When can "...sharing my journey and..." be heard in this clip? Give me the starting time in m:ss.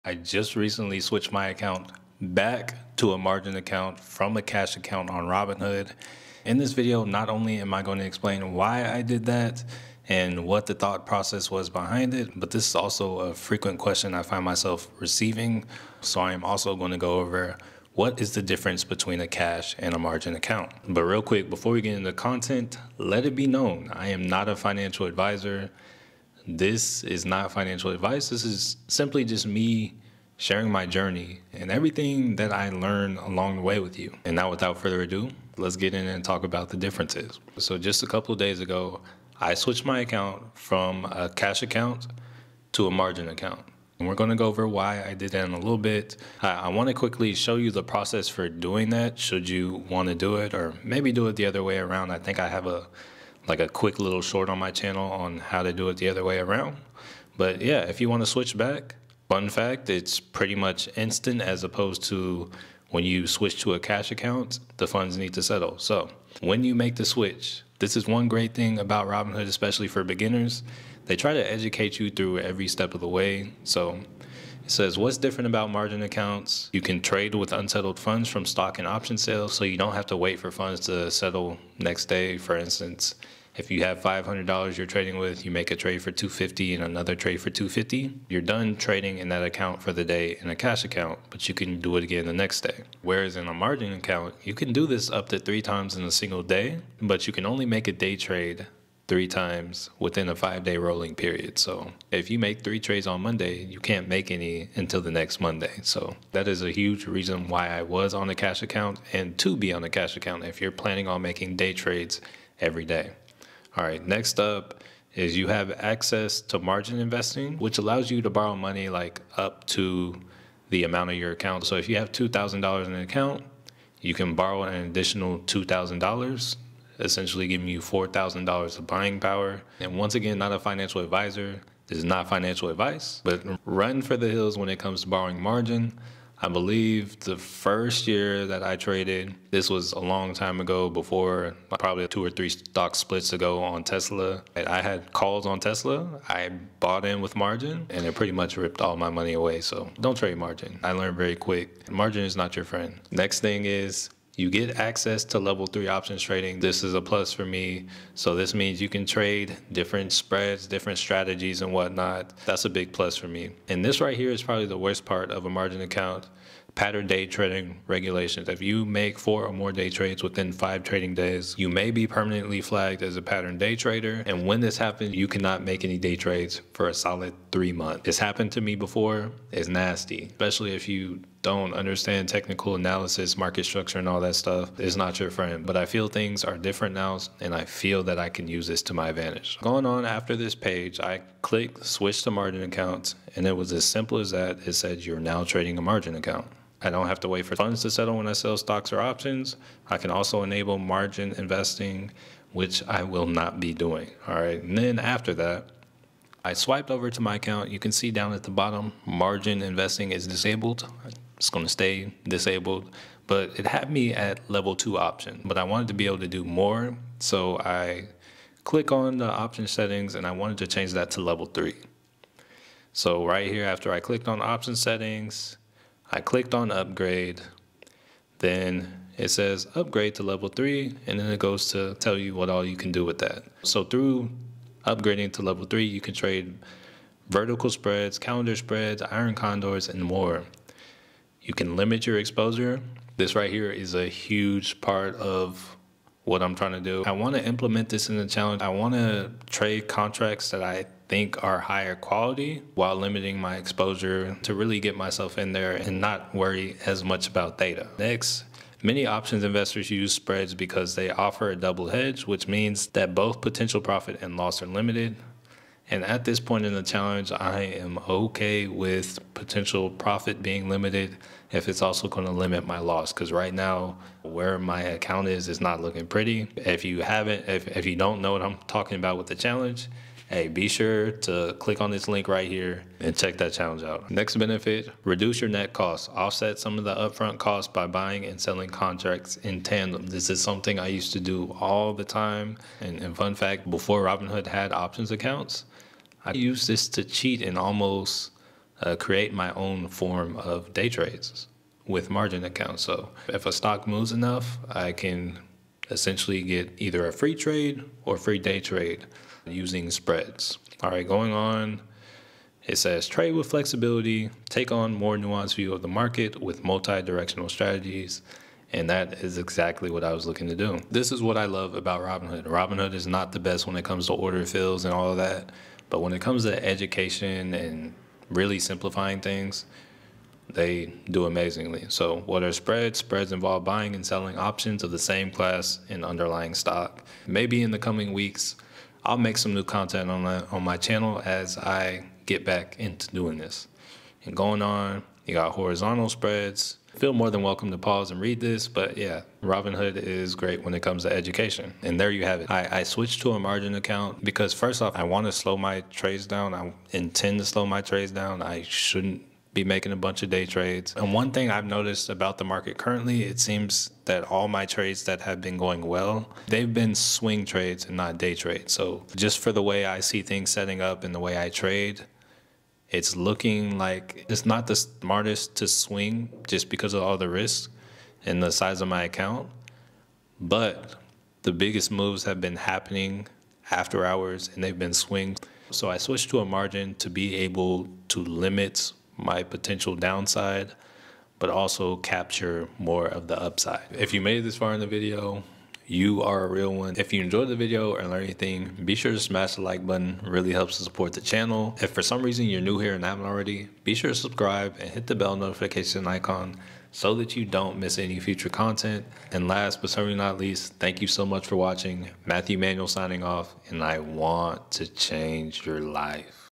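0:30.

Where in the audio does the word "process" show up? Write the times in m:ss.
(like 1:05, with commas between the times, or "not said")
0:11, 0:47.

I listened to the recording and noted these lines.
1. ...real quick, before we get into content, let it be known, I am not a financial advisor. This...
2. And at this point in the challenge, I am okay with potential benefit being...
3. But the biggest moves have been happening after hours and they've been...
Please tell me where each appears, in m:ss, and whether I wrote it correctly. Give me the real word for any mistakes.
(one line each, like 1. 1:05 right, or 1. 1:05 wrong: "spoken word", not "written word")
1. 0:21 right
2. 4:25 wrong: "profit", not "benefit"
3. 6:20 right.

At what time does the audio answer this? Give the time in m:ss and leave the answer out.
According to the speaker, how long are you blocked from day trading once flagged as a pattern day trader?
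2:57.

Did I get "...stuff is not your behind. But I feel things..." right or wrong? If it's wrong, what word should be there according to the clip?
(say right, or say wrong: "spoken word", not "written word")
wrong: "friend", not "behind".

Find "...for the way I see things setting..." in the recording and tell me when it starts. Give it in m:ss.
6:09.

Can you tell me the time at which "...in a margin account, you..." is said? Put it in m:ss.
1:33.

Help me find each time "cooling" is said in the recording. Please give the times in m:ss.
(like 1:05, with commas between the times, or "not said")
not said.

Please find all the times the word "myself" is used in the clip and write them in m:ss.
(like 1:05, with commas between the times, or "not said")
0:14, 4:14.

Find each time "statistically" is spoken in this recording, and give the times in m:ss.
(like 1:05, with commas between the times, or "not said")
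not said.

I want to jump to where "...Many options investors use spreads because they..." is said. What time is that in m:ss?
4:18.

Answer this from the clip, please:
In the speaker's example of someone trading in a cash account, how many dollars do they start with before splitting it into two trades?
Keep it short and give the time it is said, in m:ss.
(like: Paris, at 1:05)
$500, at 1:24.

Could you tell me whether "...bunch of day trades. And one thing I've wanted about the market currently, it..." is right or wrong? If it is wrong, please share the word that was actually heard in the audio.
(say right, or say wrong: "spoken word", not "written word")
wrong: "noticed", not "wanted".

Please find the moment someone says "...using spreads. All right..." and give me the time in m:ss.
5:09.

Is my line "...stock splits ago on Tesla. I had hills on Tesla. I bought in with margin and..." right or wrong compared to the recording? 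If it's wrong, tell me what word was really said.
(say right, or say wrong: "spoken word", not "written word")
wrong: "calls", not "hills".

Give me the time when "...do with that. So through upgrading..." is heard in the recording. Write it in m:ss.
3:52.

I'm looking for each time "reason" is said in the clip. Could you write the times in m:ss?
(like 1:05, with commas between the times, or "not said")
1:47, 6:42.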